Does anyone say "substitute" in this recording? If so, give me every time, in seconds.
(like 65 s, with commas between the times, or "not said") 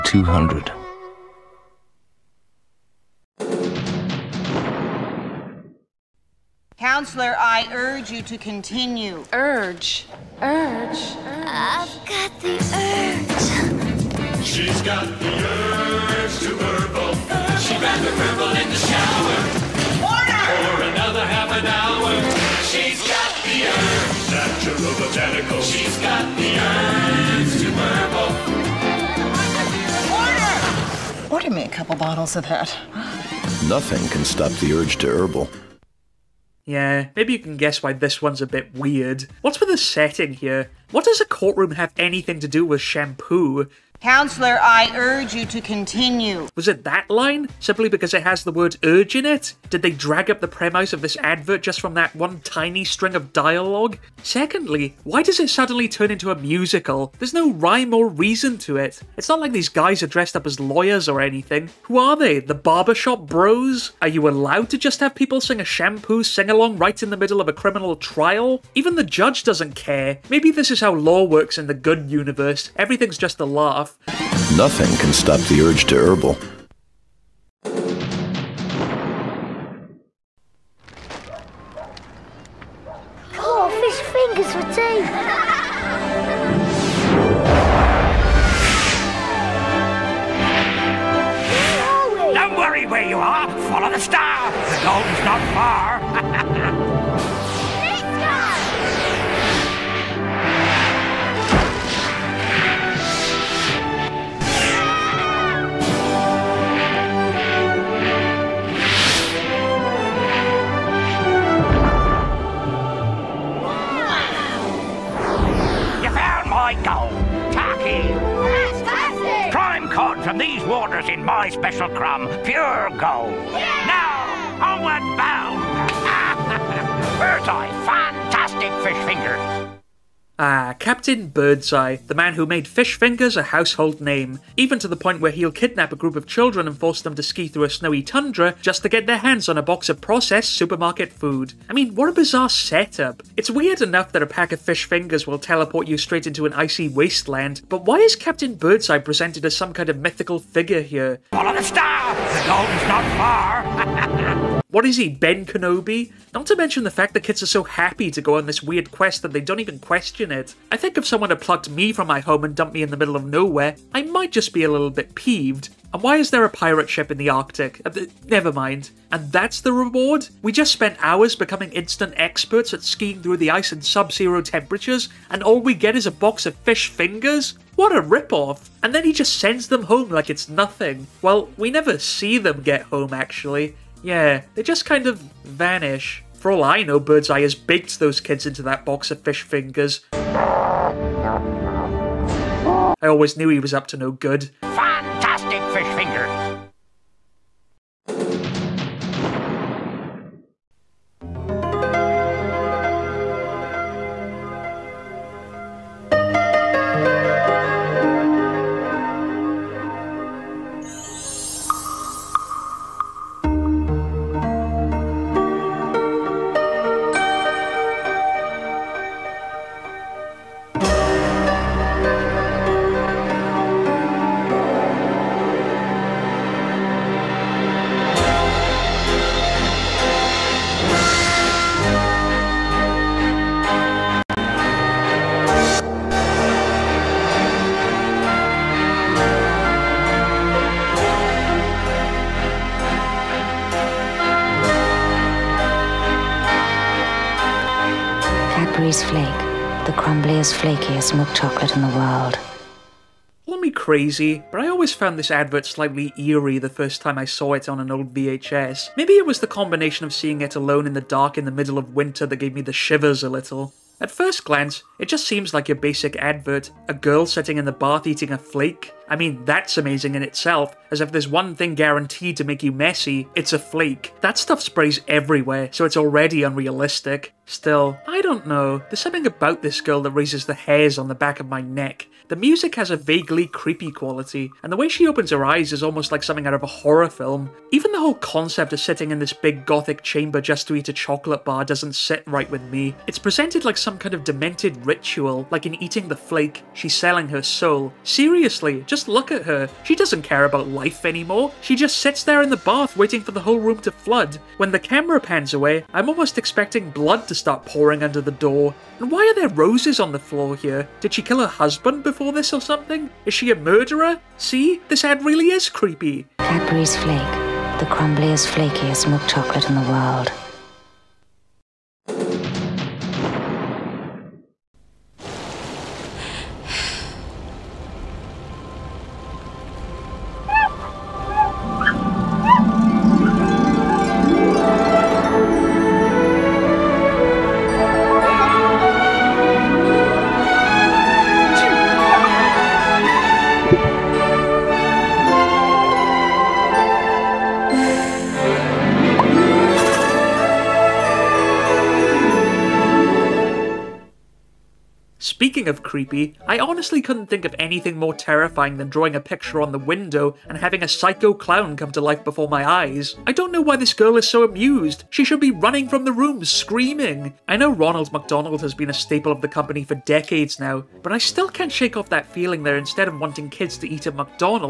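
not said.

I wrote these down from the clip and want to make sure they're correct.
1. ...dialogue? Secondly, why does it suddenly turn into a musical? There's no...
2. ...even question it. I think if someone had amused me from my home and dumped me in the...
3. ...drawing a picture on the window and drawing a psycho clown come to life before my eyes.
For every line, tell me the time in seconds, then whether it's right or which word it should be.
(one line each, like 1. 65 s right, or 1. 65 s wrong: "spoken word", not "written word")
1. 53 s right
2. 159 s wrong: "plucked", not "amused"
3. 358 s wrong: "having", not "drawing".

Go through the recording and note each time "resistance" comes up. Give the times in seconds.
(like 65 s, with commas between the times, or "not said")
not said.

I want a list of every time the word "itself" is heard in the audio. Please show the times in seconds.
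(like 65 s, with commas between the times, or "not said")
270 s.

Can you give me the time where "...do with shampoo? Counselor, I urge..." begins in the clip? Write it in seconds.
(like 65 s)
42 s.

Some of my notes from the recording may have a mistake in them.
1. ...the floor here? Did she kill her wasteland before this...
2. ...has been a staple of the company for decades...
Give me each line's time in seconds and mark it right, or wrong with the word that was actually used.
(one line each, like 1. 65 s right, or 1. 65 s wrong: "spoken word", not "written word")
1. 310 s wrong: "husband", not "wasteland"
2. 368 s right.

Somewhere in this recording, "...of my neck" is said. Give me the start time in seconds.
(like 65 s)
281 s.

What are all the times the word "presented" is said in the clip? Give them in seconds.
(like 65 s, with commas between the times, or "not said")
148 s, 293 s.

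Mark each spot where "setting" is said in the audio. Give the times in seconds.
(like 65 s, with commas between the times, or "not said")
39 s.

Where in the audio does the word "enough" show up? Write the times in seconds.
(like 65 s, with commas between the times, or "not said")
143 s.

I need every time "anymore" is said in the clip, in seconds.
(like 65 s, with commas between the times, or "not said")
301 s.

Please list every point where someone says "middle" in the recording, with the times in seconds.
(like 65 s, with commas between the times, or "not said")
67 s, 162 s, 261 s.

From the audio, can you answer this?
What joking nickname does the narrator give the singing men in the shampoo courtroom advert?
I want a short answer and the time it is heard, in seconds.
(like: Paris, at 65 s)
The barbershop bros, at 62 s.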